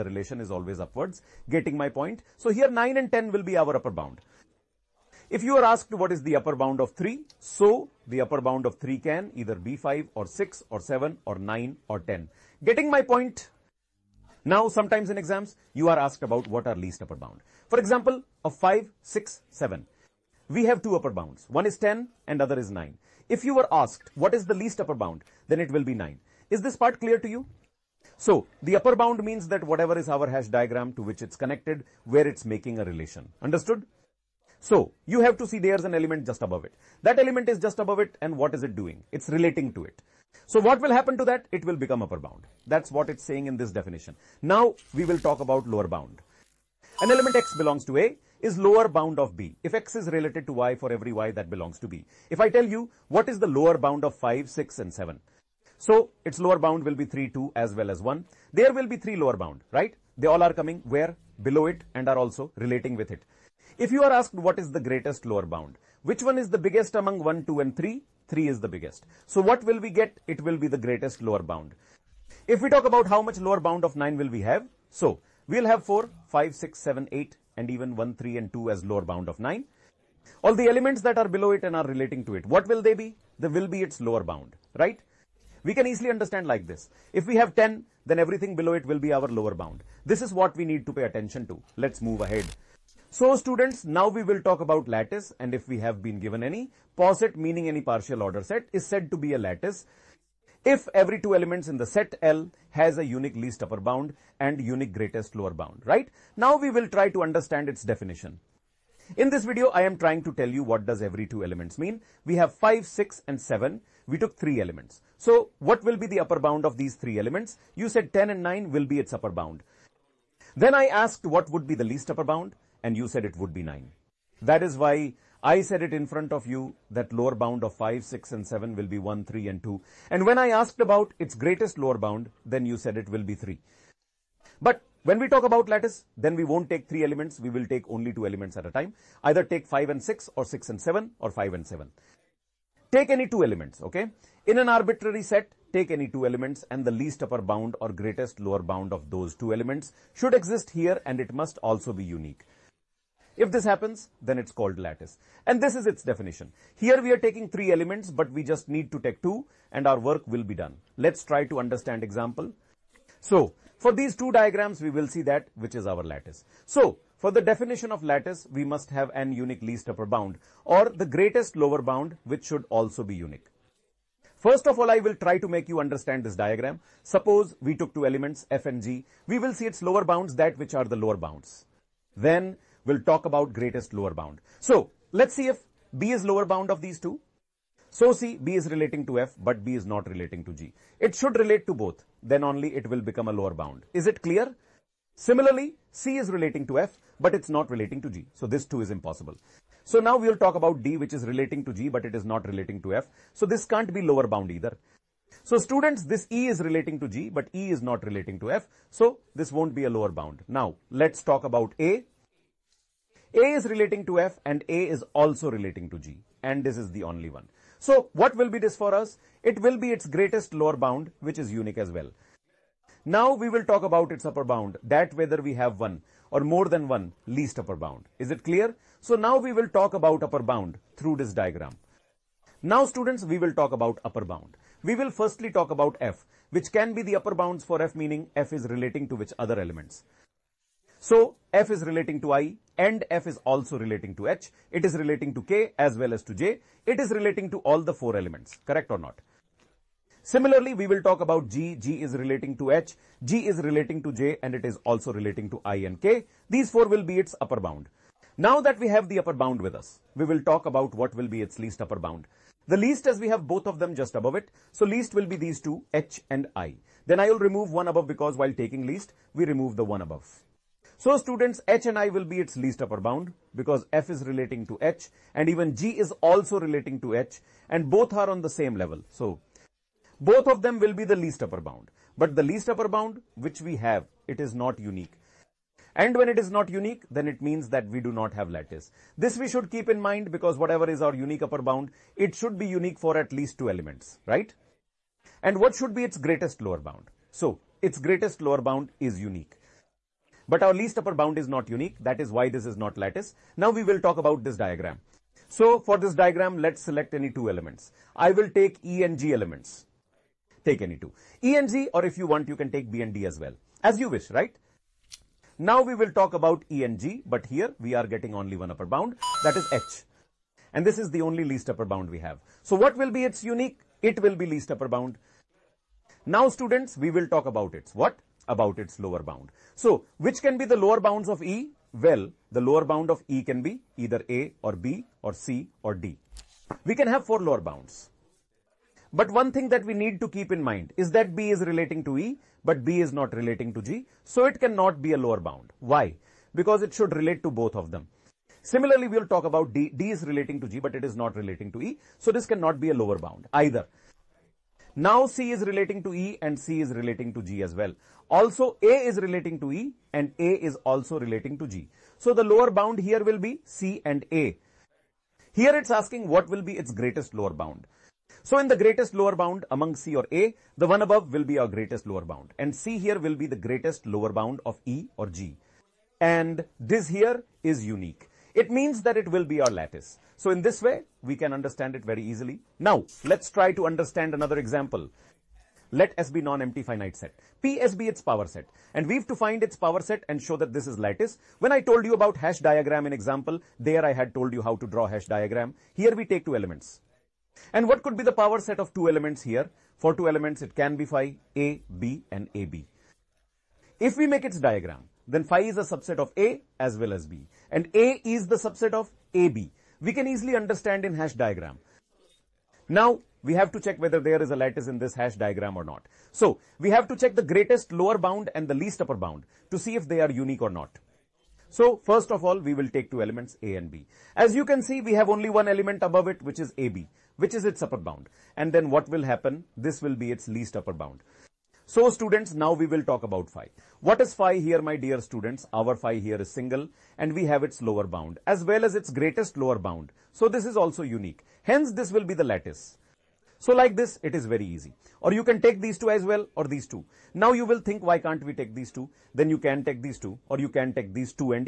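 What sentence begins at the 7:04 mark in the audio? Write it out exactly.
As you can see, we have only one element above it, which is AB, which is its upper bound.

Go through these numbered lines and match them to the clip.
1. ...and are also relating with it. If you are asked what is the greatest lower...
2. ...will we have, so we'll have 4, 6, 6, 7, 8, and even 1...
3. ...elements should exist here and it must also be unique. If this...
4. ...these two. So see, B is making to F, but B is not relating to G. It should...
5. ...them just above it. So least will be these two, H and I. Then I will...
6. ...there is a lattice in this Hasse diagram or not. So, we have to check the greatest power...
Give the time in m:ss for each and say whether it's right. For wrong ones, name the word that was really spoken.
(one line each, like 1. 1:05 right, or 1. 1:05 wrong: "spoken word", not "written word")
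1. 1:01 right
2. 1:14 wrong: "5", not "6"
3. 2:29 right
4. 3:06 wrong: "relating", not "making"
5. 4:23 right
6. 6:54 wrong: "lower", not "power".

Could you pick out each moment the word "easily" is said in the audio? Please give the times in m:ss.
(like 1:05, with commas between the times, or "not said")
1:25, 6:22, 6:50.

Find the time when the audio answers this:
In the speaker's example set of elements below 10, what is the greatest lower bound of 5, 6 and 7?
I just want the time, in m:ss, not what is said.
1:08.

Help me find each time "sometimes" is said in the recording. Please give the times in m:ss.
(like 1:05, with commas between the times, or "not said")
0:14.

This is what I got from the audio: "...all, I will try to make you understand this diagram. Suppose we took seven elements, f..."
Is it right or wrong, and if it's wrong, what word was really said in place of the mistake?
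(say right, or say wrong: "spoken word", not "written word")
wrong: "two", not "seven".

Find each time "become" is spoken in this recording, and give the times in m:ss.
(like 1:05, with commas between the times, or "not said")
0:41, 3:13.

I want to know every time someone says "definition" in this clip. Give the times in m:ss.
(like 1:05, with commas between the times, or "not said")
0:43, 1:47, 2:36, 2:47.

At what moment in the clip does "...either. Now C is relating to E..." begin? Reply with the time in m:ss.
5:53.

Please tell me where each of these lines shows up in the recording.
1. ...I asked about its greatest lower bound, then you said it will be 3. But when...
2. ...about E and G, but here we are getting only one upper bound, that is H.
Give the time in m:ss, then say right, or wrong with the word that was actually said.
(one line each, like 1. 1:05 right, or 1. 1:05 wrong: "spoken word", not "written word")
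1. 2:10 right
2. 5:16 right.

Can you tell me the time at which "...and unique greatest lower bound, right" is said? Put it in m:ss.
1:44.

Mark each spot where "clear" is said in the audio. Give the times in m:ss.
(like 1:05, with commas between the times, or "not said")
0:27, 3:14, 3:48.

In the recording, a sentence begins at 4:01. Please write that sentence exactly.
So f is relating to i and f is also relating to h.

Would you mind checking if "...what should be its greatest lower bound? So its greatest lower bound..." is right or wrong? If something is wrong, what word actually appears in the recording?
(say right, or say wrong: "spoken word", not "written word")
right.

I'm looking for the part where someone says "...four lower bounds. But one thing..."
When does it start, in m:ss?
5:37.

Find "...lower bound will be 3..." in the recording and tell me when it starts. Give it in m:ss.
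0:56.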